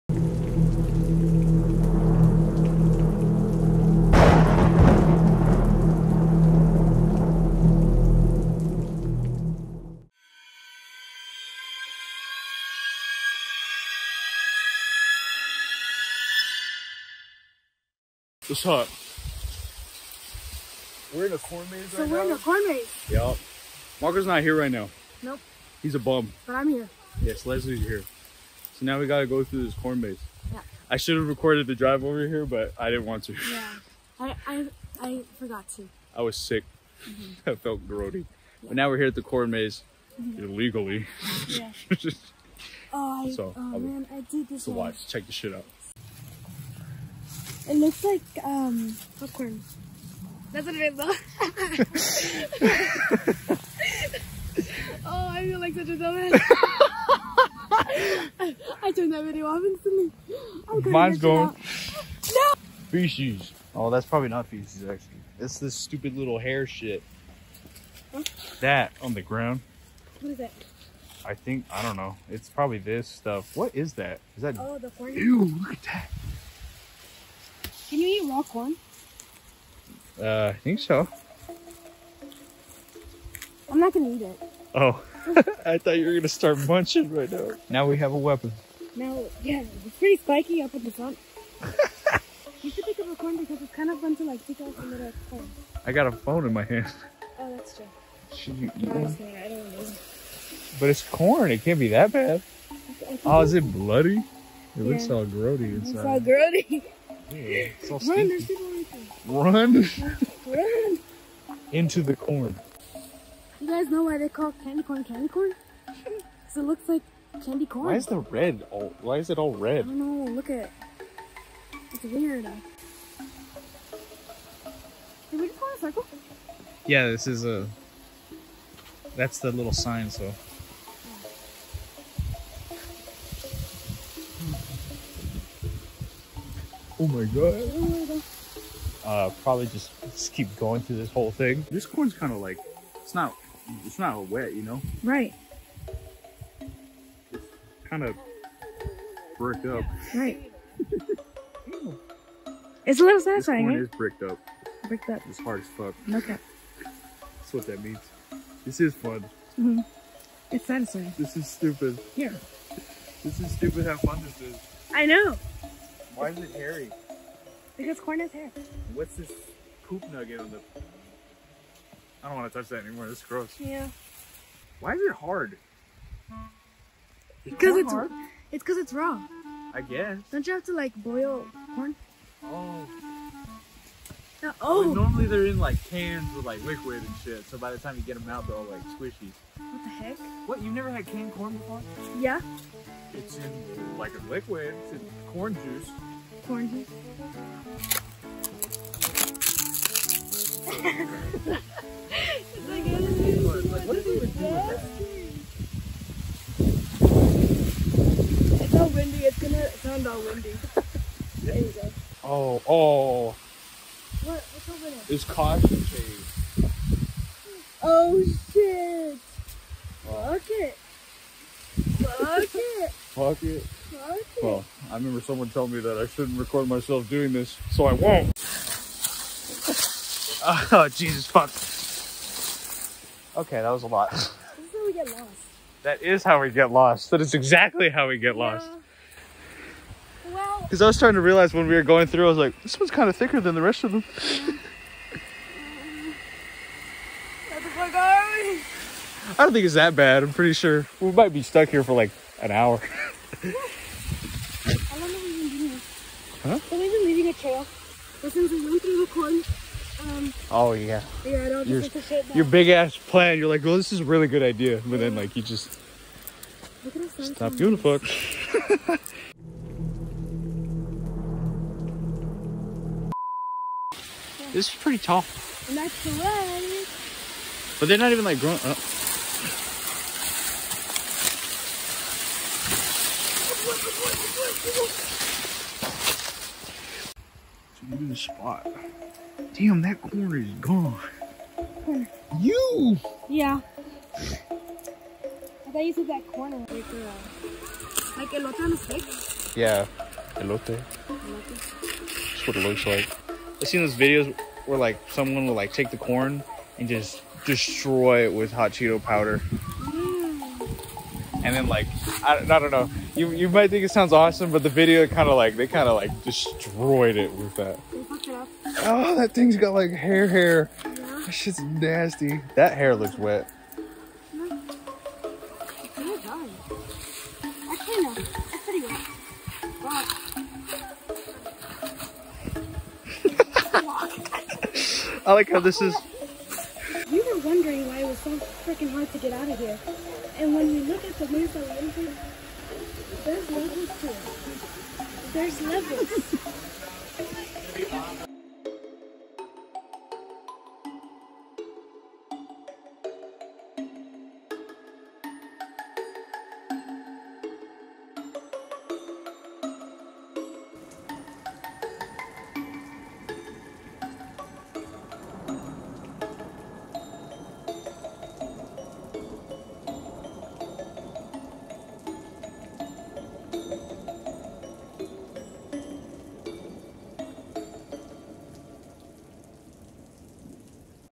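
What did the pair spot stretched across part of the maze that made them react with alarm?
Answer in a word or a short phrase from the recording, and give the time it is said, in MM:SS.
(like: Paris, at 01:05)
caution tape, at 03:35.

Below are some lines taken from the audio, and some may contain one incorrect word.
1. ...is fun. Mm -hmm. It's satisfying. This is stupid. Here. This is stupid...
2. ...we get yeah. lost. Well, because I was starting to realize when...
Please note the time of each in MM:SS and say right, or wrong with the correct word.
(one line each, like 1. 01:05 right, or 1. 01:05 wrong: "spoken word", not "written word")
1. 02:38 right
2. 03:58 right.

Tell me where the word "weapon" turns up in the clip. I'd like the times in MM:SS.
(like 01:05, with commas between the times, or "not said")
01:28.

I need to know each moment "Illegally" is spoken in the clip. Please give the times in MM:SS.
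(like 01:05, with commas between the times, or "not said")
00:40.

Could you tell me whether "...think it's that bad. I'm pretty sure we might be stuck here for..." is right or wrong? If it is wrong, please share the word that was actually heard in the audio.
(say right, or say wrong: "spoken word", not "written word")
right.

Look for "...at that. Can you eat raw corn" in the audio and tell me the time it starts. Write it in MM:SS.
01:15.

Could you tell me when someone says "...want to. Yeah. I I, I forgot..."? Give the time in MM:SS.
00:33.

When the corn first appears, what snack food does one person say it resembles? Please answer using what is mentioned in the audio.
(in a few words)
popcorn.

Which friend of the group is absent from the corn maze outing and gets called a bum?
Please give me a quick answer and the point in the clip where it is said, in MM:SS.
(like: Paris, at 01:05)
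Marco, at 00:24.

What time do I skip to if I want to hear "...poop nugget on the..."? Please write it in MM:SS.
02:49.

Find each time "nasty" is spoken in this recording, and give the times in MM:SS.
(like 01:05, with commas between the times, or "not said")
05:21.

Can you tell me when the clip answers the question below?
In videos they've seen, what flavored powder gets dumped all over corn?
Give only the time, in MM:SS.
05:08.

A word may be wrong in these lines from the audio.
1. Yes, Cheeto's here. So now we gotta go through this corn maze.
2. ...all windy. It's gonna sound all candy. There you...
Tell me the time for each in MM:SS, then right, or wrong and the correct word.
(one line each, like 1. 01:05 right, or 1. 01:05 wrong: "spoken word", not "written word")
1. 00:27 wrong: "Leslie", not "Cheeto"
2. 03:28 wrong: "windy", not "candy".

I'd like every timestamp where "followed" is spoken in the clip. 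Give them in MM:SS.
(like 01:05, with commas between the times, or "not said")
not said.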